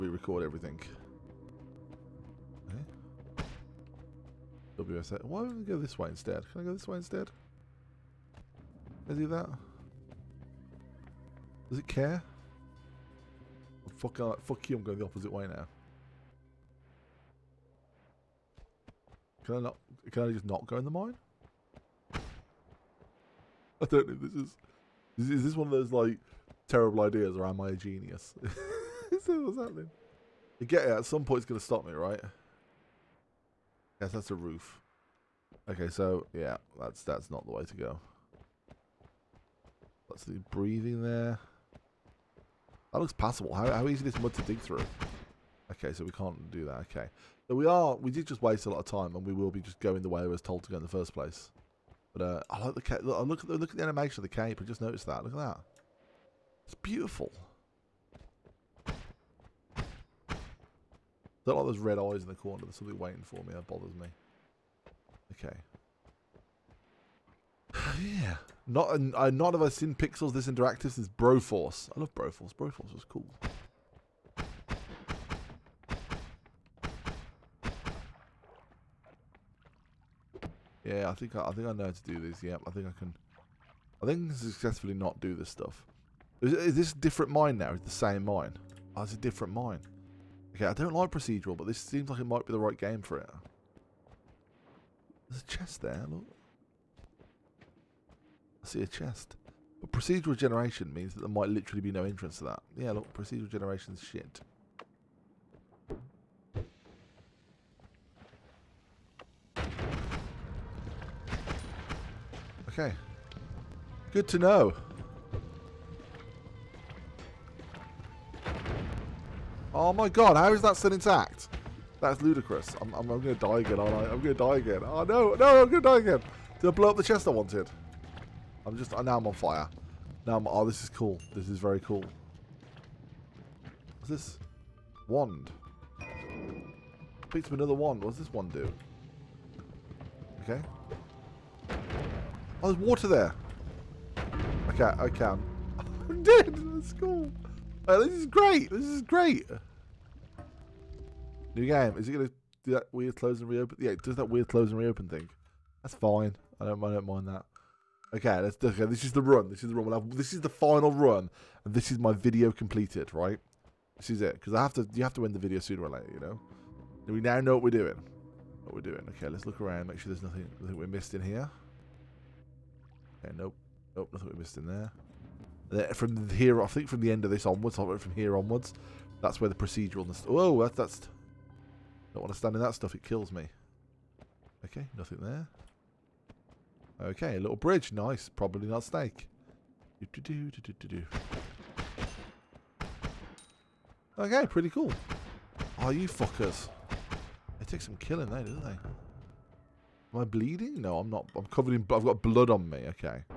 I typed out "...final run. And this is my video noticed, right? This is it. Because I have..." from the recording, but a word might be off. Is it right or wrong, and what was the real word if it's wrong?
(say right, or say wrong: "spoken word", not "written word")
wrong: "completed", not "noticed".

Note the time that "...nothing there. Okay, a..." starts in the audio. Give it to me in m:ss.
3:04.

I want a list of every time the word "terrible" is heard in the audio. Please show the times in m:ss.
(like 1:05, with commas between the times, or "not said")
0:26.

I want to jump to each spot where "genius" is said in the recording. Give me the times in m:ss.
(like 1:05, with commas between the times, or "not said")
0:27.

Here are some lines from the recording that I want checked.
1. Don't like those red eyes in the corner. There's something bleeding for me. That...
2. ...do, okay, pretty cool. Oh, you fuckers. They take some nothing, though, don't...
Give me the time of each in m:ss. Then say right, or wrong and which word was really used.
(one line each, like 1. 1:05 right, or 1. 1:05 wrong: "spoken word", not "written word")
1. 1:01 wrong: "waiting", not "bleeding"
2. 3:10 wrong: "killing", not "nothing".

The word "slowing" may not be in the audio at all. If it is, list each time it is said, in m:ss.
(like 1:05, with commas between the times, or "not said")
not said.